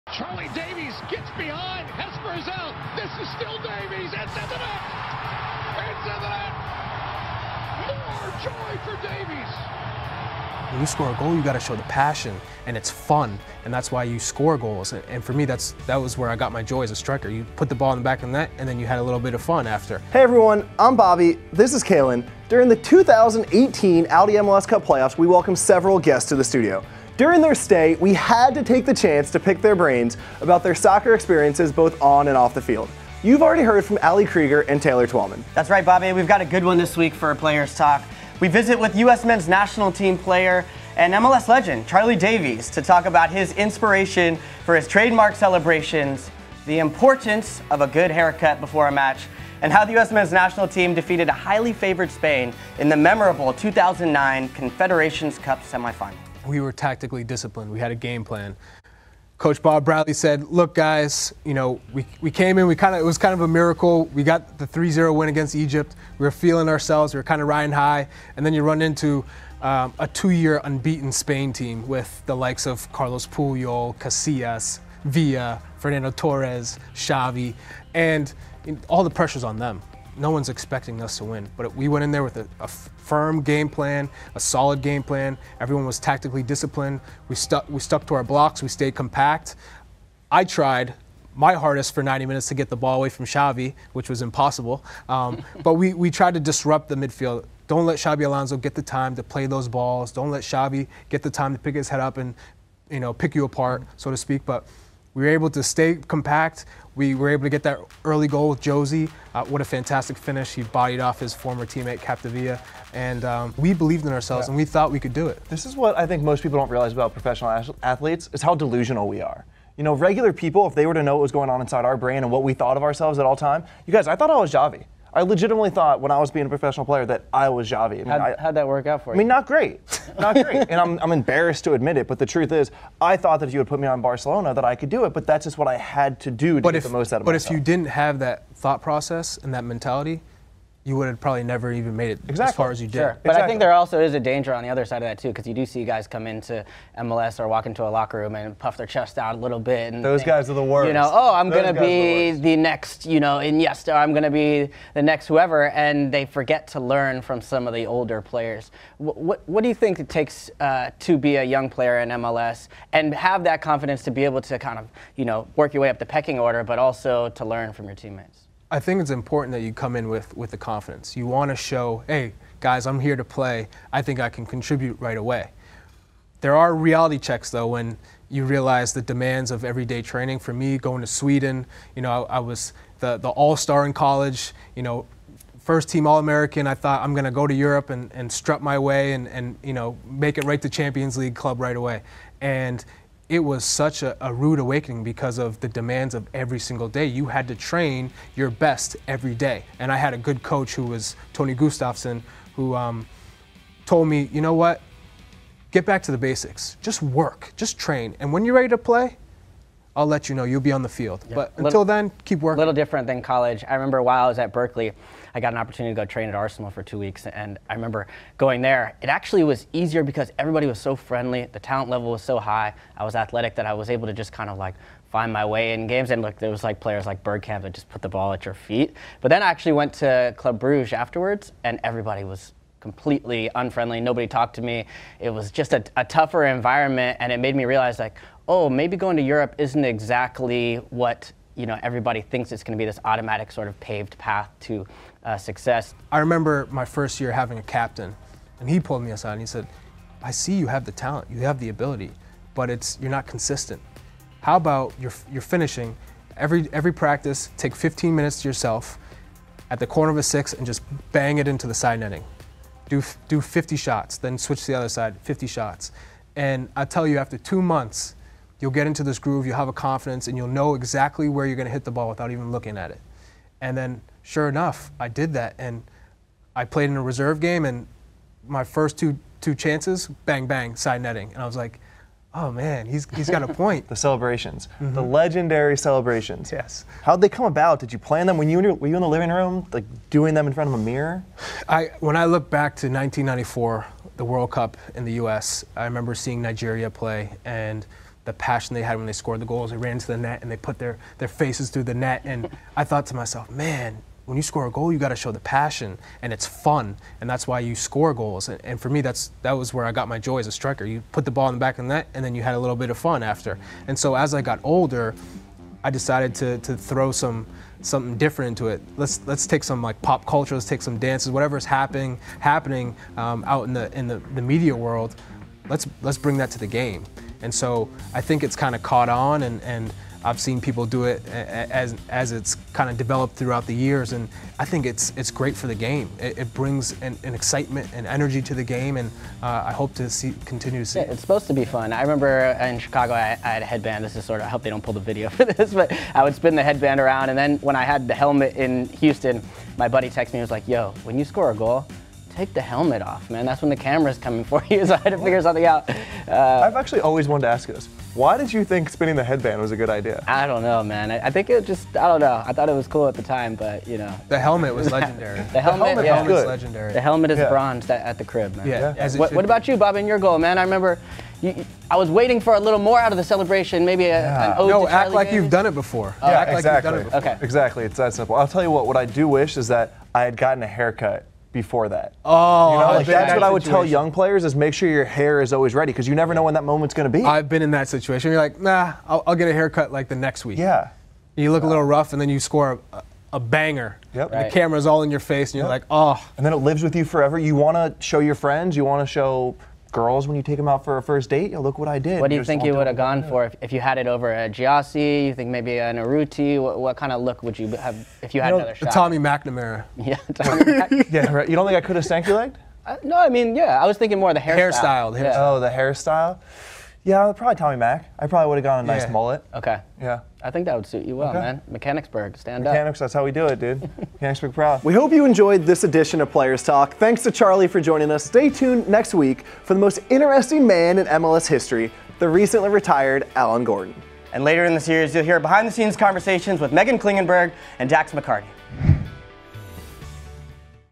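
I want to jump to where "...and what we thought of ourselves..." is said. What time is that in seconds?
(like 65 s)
122 s.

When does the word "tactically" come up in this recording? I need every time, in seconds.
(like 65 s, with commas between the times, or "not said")
56 s, 85 s.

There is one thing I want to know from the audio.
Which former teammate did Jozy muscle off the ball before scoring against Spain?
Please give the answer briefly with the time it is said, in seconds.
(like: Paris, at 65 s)
Capdevila, at 111 s.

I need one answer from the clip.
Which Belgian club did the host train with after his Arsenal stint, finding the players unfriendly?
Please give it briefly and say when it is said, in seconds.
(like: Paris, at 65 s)
Club Bruges, at 230 s.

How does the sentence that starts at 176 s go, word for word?
There are reality checks though when you realize the demands of everyday training.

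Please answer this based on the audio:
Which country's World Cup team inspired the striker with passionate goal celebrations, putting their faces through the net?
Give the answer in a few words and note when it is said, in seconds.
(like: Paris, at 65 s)
Nigeria, at 296 s.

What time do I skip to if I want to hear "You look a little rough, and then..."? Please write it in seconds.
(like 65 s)
391 s.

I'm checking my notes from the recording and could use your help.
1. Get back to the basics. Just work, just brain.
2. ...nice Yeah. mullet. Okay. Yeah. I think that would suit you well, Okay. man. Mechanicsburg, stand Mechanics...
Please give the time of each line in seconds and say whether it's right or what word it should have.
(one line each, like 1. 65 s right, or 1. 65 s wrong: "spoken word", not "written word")
1. 205 s wrong: "train", not "brain"
2. 418 s right.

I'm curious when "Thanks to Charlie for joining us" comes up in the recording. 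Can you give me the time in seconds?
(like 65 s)
426 s.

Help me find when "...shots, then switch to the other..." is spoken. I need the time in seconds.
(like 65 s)
263 s.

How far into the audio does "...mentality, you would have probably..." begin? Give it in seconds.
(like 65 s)
139 s.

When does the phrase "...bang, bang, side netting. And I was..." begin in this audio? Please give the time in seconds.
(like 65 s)
280 s.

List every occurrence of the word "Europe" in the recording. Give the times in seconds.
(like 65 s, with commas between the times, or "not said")
187 s, 239 s.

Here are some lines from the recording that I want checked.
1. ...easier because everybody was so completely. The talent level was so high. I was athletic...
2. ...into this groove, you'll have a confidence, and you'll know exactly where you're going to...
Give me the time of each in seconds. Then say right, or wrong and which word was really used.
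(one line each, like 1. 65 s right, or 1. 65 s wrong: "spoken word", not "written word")
1. 219 s wrong: "friendly", not "completely"
2. 268 s right.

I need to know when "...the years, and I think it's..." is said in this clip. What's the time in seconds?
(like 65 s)
333 s.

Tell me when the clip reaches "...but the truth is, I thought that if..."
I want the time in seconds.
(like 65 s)
132 s.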